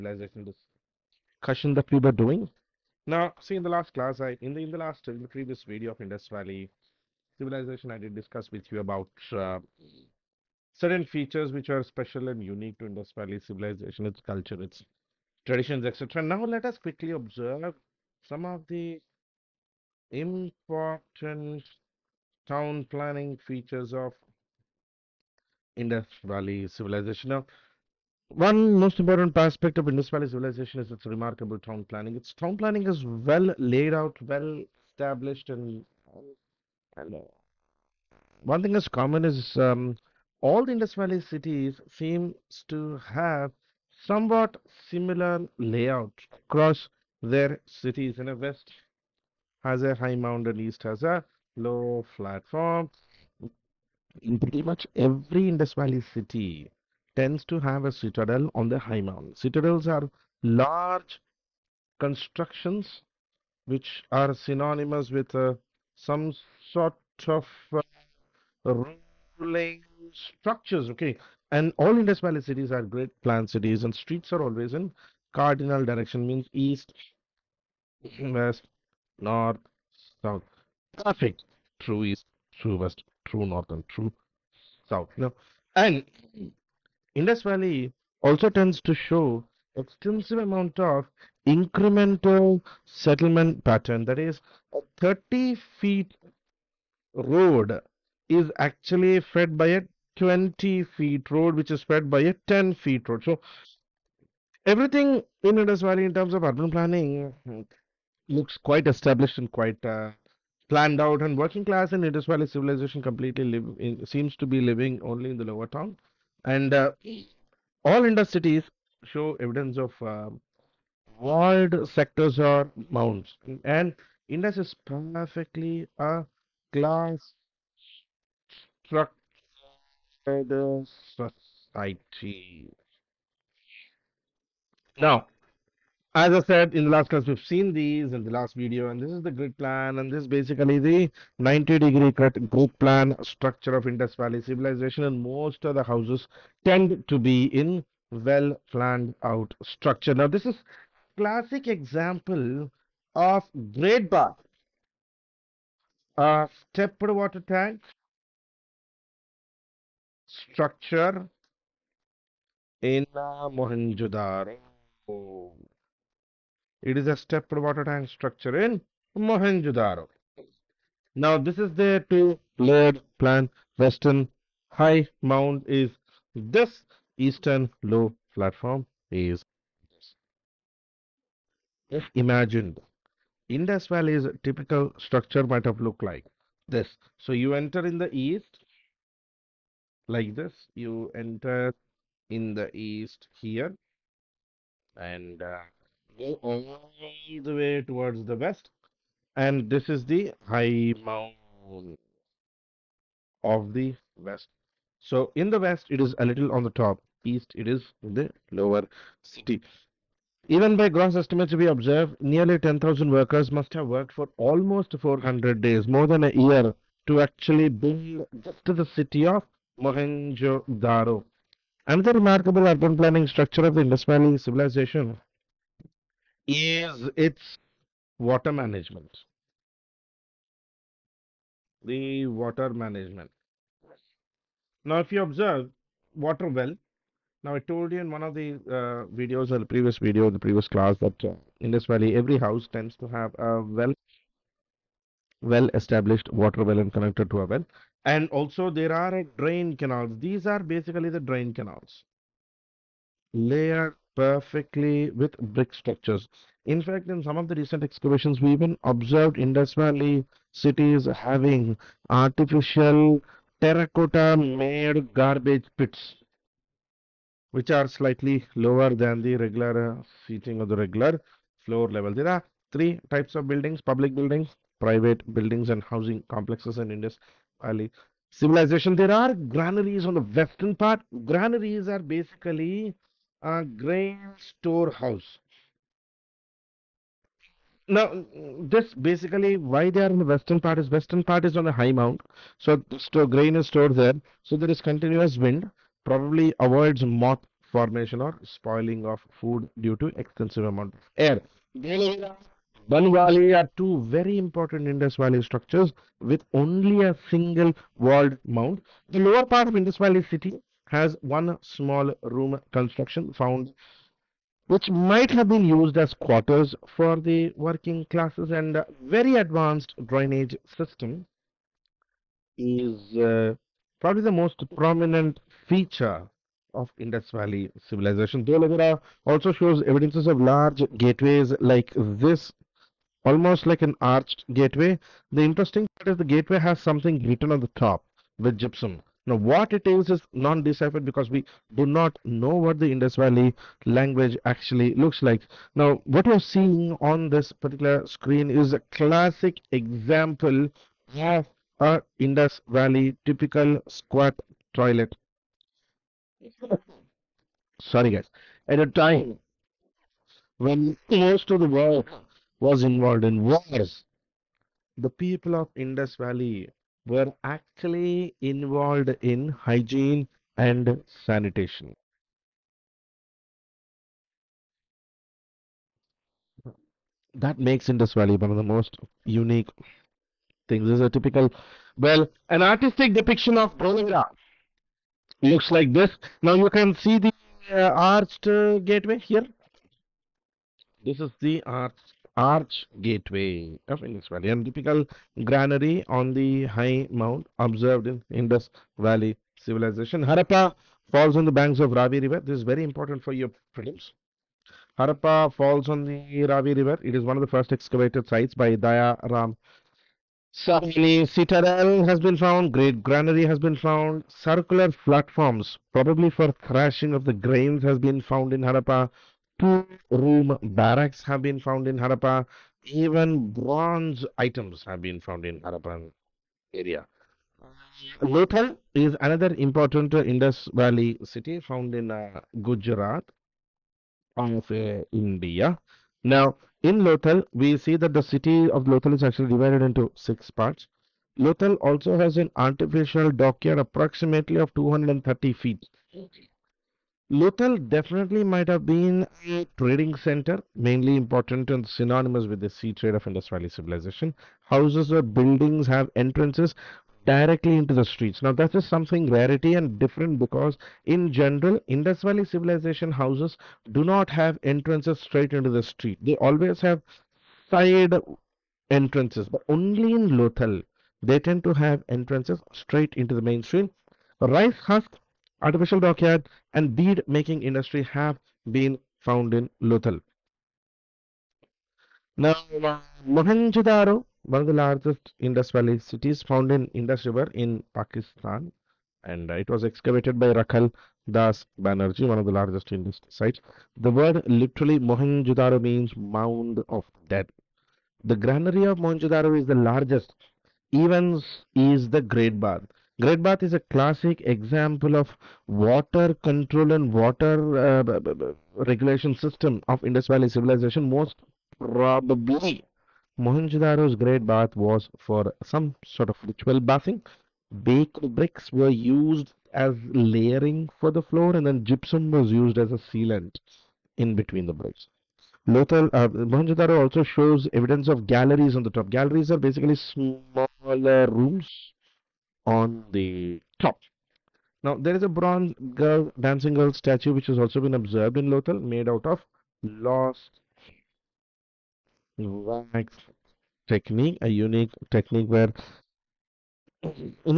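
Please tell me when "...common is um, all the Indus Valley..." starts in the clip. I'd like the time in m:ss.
0:38.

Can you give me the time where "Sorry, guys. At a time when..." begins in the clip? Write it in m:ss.
5:57.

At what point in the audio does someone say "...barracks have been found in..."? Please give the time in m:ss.
7:00.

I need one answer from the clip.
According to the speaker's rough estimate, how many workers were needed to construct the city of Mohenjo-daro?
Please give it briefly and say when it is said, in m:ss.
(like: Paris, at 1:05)
10,000, at 3:32.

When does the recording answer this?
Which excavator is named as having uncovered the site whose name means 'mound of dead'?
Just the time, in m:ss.
8:10.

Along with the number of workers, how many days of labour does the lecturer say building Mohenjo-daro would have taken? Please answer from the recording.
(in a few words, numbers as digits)
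400 days.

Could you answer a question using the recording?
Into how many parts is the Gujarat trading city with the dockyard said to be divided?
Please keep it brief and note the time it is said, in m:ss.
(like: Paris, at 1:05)
6, at 7:20.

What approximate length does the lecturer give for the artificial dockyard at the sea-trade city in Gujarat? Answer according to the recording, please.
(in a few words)
230 feet.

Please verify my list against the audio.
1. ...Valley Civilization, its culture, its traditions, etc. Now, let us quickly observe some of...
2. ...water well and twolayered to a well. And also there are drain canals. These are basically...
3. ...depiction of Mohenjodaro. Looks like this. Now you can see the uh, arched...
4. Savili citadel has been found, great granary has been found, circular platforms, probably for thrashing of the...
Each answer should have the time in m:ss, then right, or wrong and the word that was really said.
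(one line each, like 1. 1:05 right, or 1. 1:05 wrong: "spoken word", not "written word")
1. 0:13 right
2. 4:06 wrong: "connected", not "twolayered"
3. 6:23 wrong: "Dholavira", not "Mohenjodaro"
4. 6:50 right.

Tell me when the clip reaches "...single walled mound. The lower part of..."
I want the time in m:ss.
5:07.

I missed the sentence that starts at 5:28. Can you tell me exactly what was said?
Dholavira also shows evidences of large gateways like this, almost like an arched gateway.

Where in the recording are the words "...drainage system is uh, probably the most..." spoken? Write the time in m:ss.
5:20.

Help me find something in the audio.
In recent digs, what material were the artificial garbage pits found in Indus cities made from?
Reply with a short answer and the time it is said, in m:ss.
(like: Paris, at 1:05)
Terracotta, at 4:23.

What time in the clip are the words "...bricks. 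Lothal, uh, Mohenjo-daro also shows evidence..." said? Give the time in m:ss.
8:44.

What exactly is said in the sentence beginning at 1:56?
And uh, all Indus cities show evidence of uh, walled sectors or mounds.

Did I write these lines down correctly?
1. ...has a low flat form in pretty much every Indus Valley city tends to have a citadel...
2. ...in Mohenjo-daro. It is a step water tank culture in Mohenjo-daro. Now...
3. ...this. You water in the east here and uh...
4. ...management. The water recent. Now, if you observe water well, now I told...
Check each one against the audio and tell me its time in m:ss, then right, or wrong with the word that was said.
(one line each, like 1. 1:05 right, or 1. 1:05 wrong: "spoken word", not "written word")
1. 0:50 right
2. 2:42 wrong: "structure", not "culture"
3. 3:10 wrong: "enter", not "water"
4. 3:48 wrong: "management", not "recent".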